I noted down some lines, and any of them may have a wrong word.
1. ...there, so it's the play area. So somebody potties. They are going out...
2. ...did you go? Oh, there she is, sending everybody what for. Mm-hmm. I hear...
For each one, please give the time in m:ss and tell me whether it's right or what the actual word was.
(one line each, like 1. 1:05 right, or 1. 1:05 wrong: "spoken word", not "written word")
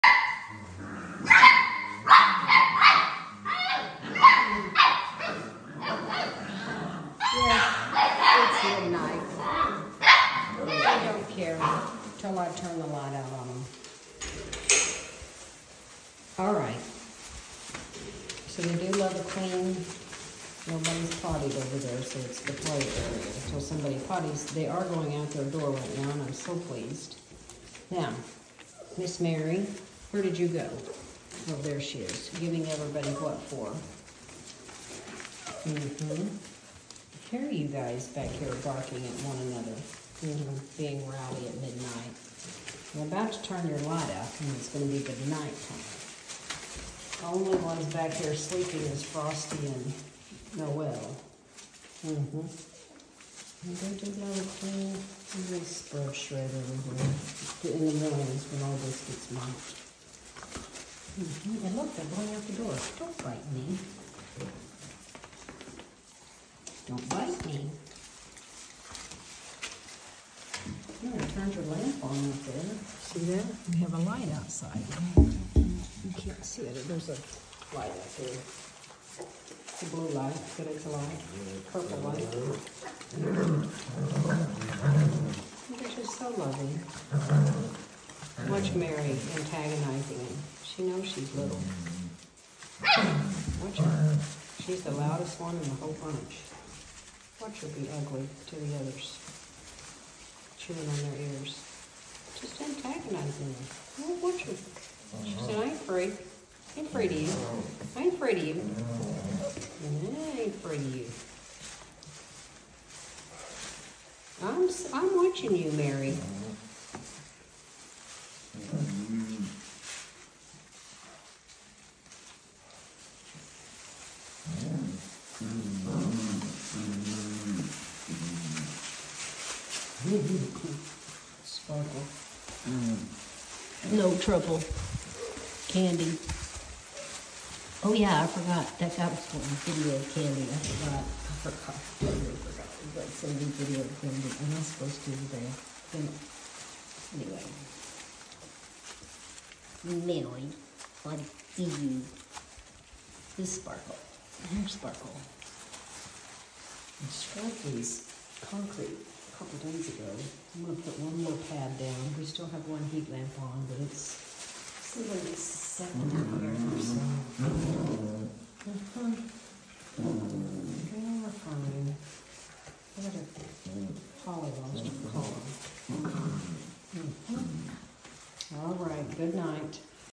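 1. 0:21 right
2. 0:30 wrong: "giving", not "sending".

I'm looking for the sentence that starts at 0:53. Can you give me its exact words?
And they do that clean this scrub shred everywhere in the mornings when all this gets mopped.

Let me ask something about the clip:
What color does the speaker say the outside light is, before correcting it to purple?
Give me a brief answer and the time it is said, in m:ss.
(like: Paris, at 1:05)
Blue, at 1:19.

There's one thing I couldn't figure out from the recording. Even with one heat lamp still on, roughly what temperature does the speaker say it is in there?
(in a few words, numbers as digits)
70.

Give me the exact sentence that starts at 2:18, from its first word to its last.
That guy was doing video of Candy.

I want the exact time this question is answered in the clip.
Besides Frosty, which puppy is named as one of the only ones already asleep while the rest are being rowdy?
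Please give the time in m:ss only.
0:50.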